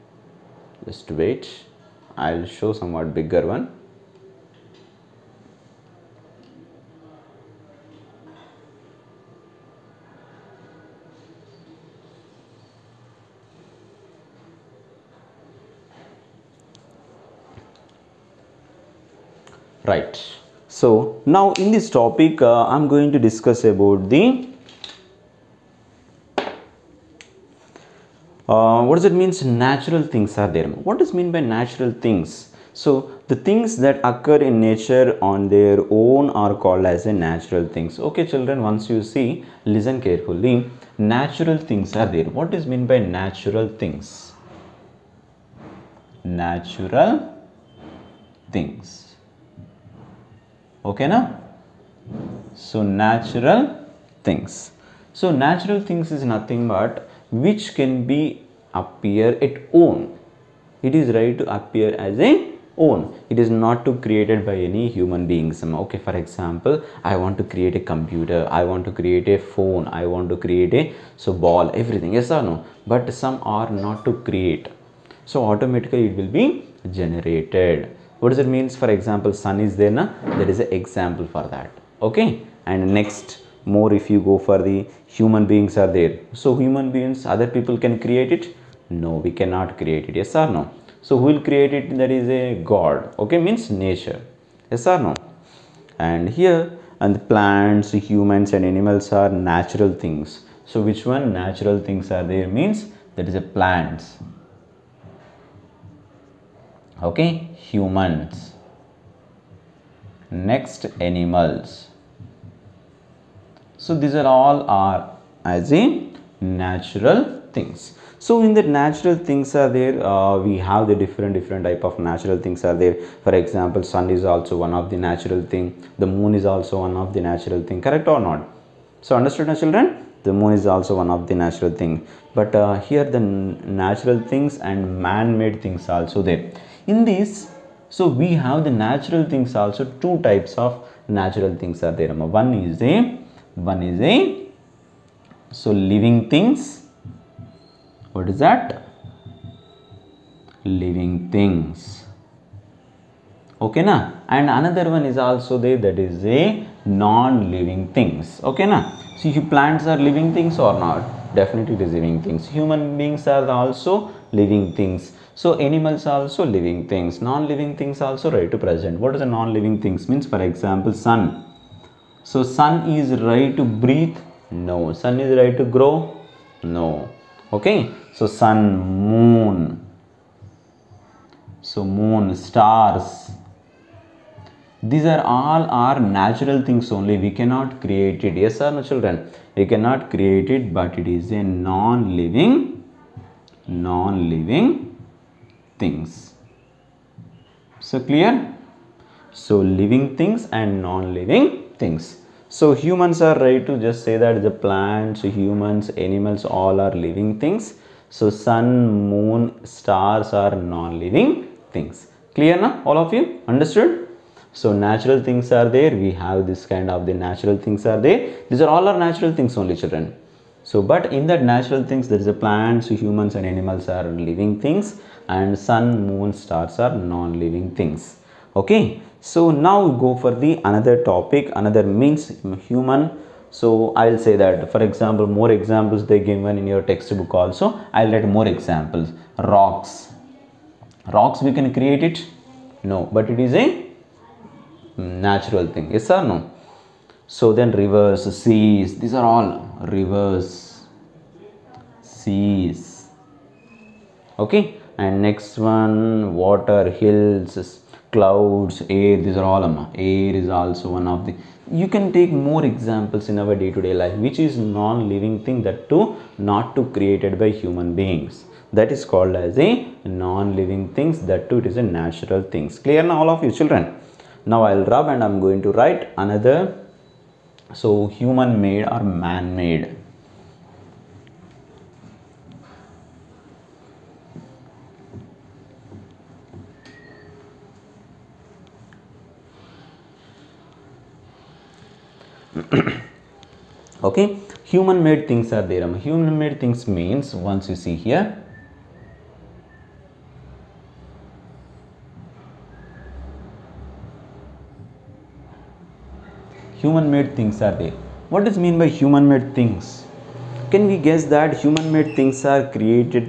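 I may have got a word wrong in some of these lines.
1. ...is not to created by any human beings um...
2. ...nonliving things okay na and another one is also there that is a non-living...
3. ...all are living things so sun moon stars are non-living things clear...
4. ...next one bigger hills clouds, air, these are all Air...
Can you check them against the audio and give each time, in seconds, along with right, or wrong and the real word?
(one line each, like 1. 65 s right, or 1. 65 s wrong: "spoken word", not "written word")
1. 63 s right
2. 150 s wrong: "living", not "nonliving"
3. 206 s right
4. 255 s wrong: "water", not "bigger".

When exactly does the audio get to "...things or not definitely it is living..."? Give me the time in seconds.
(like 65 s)
160 s.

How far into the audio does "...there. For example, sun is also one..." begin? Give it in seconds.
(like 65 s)
122 s.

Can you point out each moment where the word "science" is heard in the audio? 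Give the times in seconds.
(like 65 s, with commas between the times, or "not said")
not said.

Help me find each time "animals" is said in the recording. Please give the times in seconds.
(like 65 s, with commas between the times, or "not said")
98 s, 110 s, 165 s, 206 s, 223 s.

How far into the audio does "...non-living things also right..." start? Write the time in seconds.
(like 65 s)
167 s.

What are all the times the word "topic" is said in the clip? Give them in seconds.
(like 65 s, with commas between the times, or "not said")
21 s, 231 s.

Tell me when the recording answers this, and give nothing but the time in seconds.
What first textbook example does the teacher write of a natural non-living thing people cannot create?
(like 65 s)
239 s.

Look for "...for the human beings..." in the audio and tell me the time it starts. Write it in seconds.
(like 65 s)
84 s.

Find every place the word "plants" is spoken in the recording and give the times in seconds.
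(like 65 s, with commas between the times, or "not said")
97 s, 103 s, 159 s, 204 s, 222 s.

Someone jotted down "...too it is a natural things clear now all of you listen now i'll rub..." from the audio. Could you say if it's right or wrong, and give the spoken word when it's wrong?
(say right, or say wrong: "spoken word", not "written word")
wrong: "children", not "listen".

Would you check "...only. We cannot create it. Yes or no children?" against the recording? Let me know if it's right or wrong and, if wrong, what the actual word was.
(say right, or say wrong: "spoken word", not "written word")
right.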